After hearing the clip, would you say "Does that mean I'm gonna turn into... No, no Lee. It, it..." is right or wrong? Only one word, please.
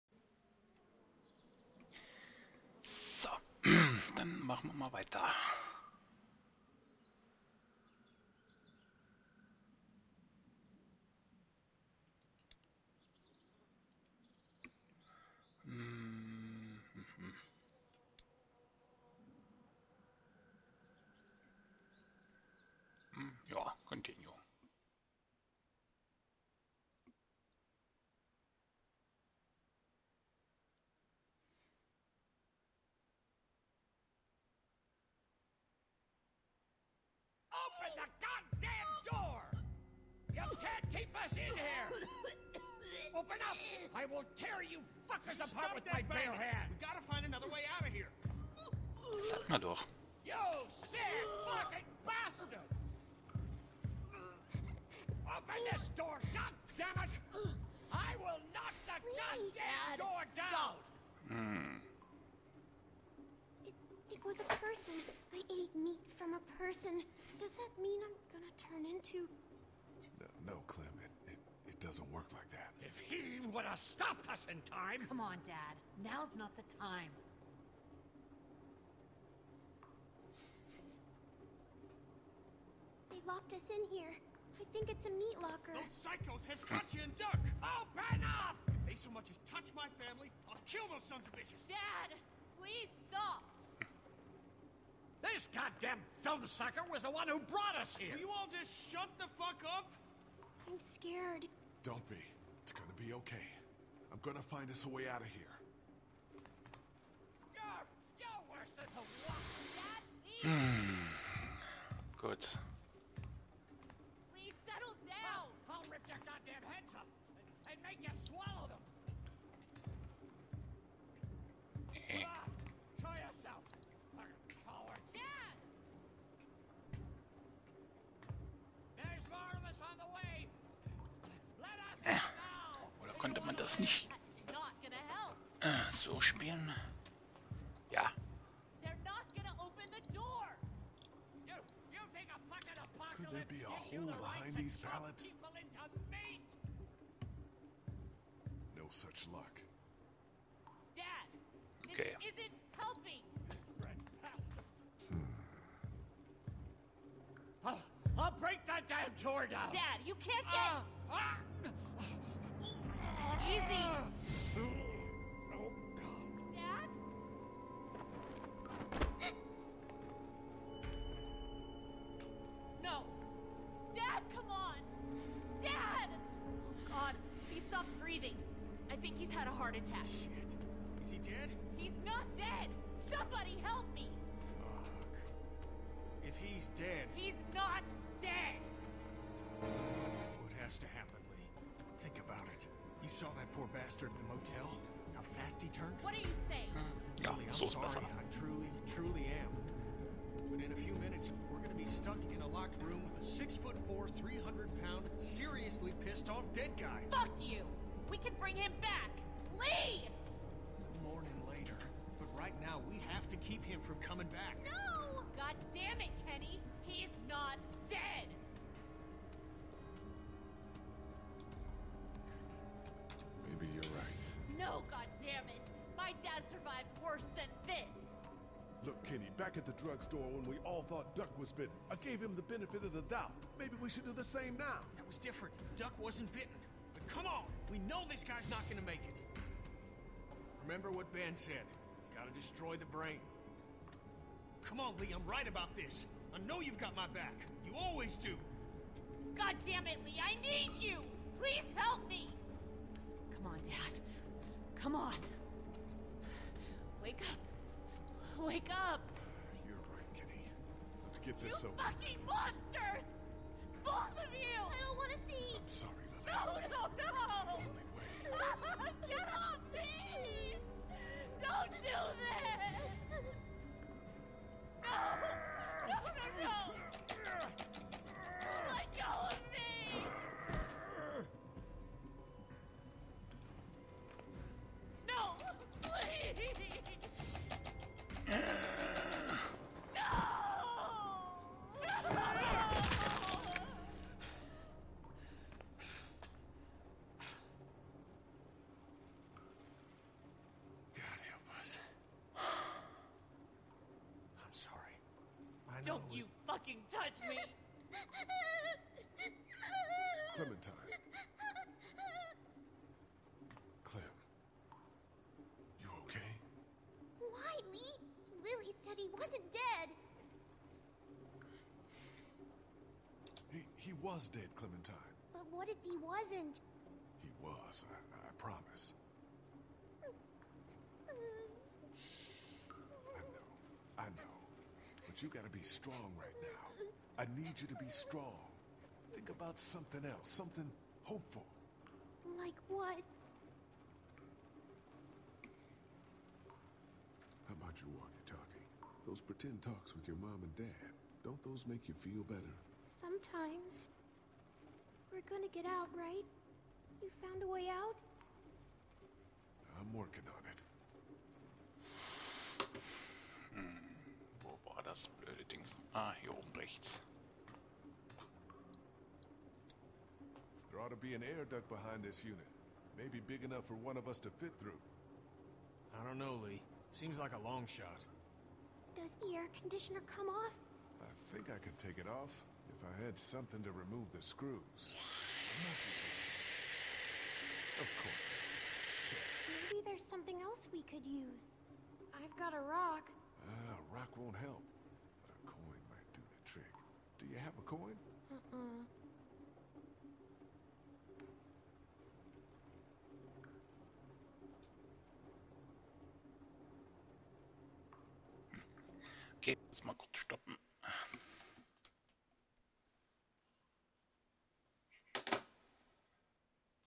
wrong.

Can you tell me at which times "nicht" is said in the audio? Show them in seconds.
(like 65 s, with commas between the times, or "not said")
133 s.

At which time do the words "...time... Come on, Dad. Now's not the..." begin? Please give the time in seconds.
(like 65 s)
74 s.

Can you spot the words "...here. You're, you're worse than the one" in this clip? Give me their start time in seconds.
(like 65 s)
105 s.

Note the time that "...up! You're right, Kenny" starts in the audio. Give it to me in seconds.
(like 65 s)
258 s.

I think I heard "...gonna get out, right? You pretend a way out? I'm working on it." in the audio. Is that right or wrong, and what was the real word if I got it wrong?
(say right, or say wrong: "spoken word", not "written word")
wrong: "found", not "pretend".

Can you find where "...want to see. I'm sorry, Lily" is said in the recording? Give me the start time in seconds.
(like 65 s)
264 s.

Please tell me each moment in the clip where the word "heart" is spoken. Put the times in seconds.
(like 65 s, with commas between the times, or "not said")
179 s.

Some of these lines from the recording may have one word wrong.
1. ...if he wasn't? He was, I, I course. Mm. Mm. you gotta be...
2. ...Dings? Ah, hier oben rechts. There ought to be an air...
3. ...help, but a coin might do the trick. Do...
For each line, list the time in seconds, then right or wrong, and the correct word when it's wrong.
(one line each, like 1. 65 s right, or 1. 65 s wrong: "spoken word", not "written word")
1. 325 s wrong: "promise", not "course"
2. 365 s right
3. 394 s right.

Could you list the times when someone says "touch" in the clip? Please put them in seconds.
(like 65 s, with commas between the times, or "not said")
89 s, 306 s.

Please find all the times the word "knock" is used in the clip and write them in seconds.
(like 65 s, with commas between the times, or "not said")
58 s.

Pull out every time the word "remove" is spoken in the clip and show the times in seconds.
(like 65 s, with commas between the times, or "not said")
383 s.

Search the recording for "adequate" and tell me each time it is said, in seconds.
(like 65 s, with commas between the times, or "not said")
not said.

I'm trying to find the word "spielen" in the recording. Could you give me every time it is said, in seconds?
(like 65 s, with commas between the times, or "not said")
136 s.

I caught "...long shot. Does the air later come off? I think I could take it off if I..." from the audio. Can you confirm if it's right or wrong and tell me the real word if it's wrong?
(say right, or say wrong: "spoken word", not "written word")
wrong: "conditioner", not "later".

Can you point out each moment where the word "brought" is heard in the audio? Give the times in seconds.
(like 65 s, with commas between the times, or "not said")
97 s.